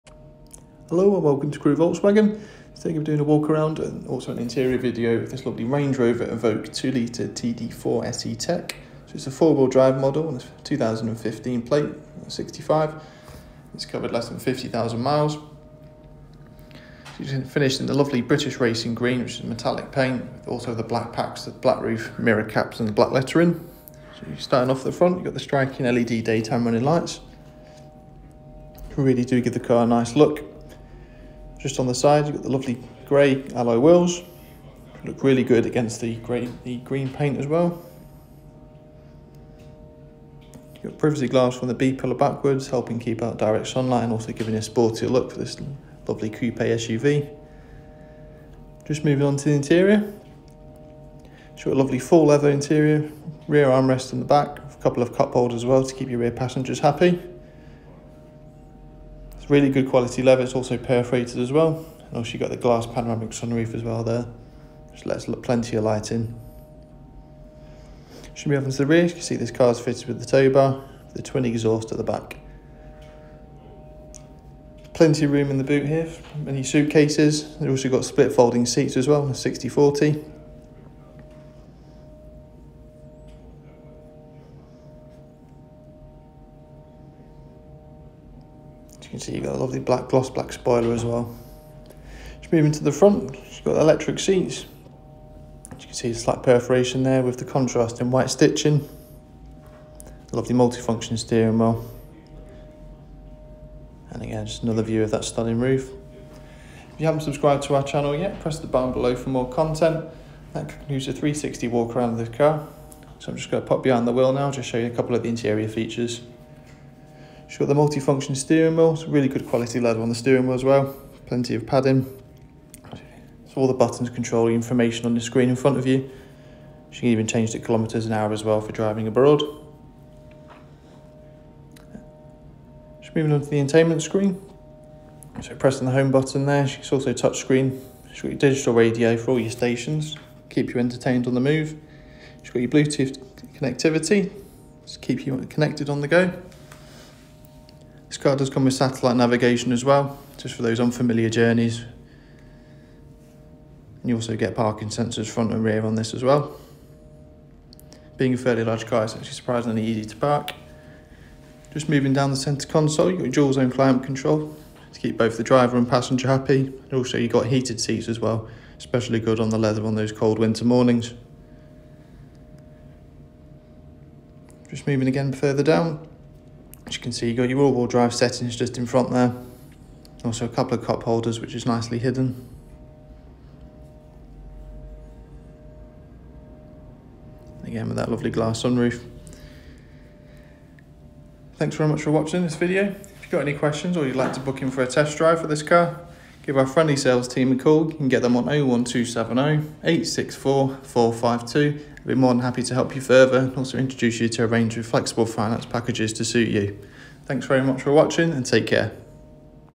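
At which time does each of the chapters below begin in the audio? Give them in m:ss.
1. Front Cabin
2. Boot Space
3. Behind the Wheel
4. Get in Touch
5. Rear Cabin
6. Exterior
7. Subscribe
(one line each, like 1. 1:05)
1. 1:31
2. 1:12
3. 1:56
4. 3:10
5. 0:50
6. 0:20
7. 1:45.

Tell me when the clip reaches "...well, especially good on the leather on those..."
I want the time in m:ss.
2:48.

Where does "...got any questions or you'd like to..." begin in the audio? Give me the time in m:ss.
3:13.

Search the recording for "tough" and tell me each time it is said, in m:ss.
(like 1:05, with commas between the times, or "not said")
not said.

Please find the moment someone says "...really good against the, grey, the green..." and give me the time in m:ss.
0:35.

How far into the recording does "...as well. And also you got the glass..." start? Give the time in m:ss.
1:01.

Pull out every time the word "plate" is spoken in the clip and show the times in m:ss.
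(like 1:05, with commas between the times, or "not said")
0:11.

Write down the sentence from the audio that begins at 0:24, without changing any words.
So you're starting off the front, you've got the striking LED daytime running lights.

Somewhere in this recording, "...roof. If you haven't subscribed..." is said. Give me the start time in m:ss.
1:45.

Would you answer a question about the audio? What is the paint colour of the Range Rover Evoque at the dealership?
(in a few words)
British Racing Green.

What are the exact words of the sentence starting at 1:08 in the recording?
Should be off into the rear.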